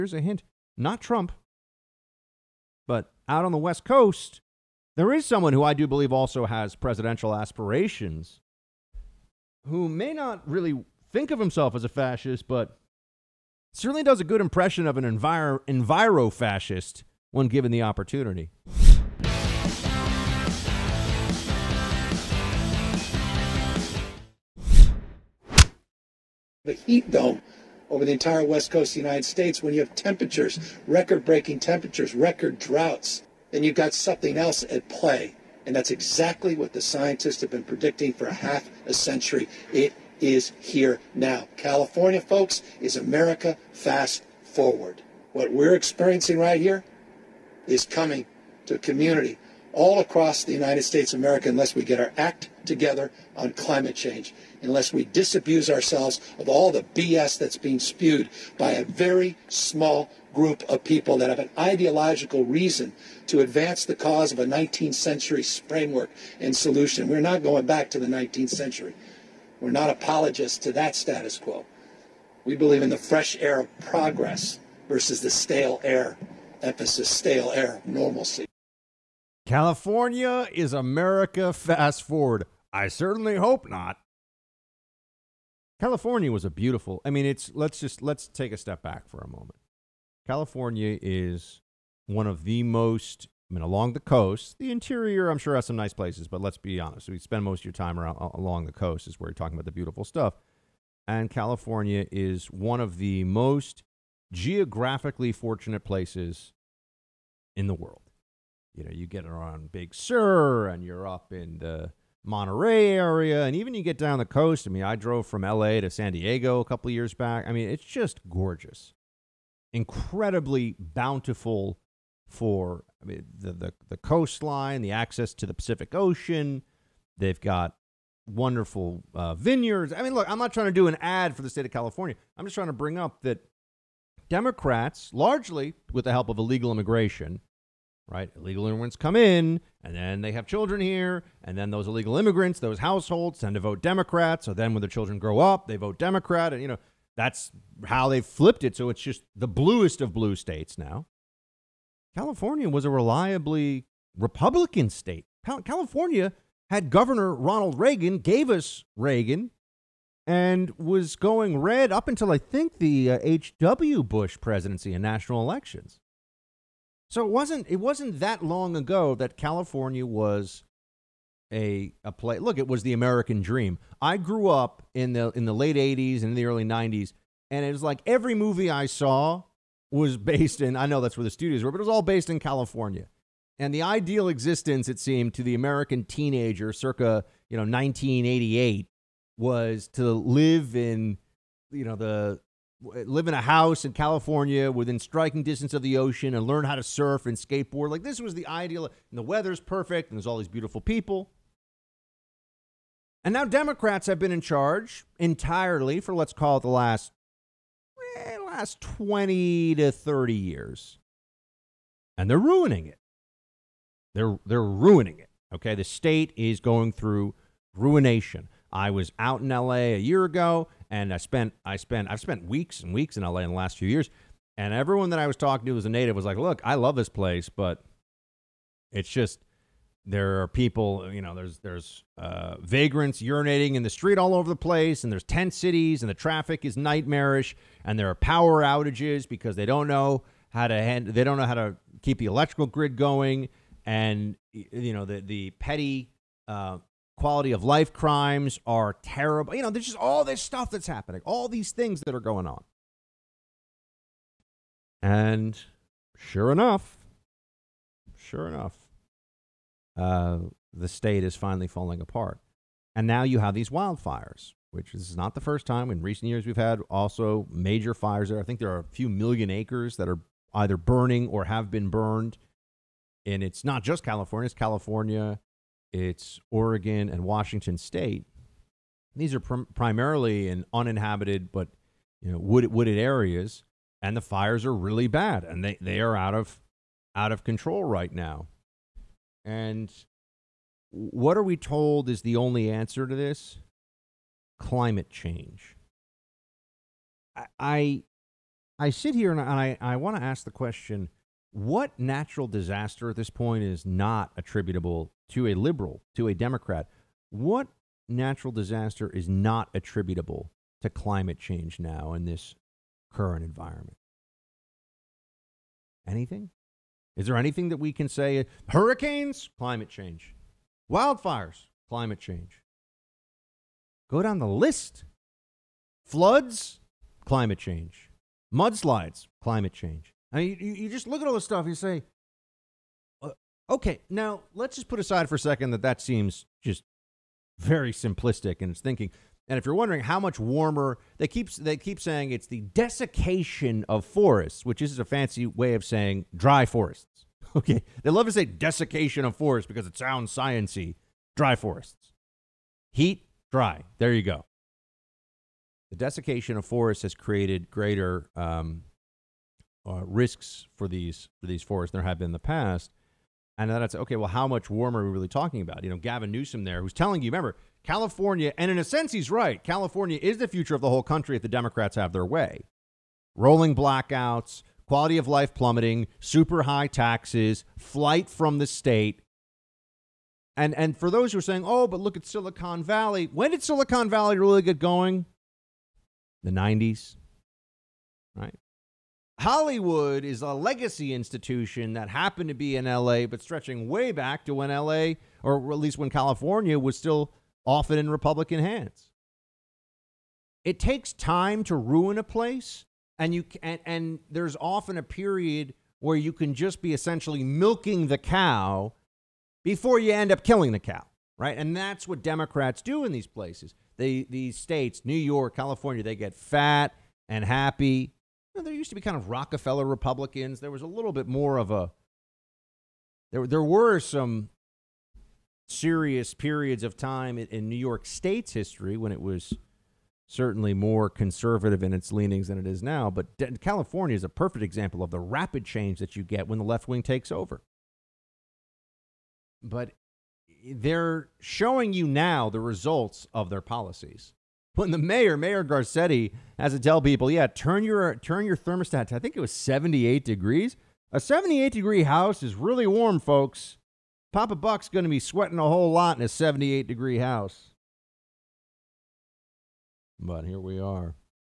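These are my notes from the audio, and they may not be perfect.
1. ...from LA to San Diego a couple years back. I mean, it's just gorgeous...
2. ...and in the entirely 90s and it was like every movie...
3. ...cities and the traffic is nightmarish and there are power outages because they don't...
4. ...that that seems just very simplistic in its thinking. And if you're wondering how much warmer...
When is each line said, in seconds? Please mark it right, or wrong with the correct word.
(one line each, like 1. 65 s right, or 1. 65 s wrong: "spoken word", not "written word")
1. 115 s right
2. 176 s wrong: "early", not "entirely"
3. 235 s right
4. 335 s right.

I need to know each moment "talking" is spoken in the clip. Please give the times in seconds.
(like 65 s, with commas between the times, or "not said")
99 s, 225 s, 365 s.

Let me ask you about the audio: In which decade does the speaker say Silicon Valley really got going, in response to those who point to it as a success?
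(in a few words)
The 90s.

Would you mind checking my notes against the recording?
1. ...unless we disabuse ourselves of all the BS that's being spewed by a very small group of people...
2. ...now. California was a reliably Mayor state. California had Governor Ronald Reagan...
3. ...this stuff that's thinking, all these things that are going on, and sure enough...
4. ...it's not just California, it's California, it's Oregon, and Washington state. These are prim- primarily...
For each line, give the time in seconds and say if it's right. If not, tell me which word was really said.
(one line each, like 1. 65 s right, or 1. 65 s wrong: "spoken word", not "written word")
1. 54 s right
2. 150 s wrong: "Republican", not "Mayor"
3. 250 s wrong: "happening", not "thinking"
4. 273 s right.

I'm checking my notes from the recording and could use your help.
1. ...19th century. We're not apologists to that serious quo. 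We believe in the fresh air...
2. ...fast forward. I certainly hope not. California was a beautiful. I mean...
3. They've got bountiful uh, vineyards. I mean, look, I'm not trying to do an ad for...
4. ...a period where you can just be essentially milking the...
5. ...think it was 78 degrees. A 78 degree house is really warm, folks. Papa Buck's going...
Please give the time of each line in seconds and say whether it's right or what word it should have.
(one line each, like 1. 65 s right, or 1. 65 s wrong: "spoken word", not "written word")
1. 68 s wrong: "status", not "serious"
2. 81 s right
3. 127 s wrong: "wonderful", not "bountiful"
4. 404 s right
5. 449 s right.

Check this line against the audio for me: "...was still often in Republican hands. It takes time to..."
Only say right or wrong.
right.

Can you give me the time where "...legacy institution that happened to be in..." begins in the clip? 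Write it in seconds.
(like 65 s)
390 s.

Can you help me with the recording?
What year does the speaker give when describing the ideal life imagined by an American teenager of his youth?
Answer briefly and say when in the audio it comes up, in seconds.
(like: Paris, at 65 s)
1988, at 187 s.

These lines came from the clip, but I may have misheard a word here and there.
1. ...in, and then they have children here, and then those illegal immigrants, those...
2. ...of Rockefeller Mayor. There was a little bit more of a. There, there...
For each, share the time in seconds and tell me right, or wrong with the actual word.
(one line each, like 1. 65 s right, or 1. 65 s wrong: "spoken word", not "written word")
1. 139 s right
2. 419 s wrong: "Republicans", not "Mayor".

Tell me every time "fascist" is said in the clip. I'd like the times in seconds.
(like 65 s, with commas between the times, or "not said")
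11 s, 16 s.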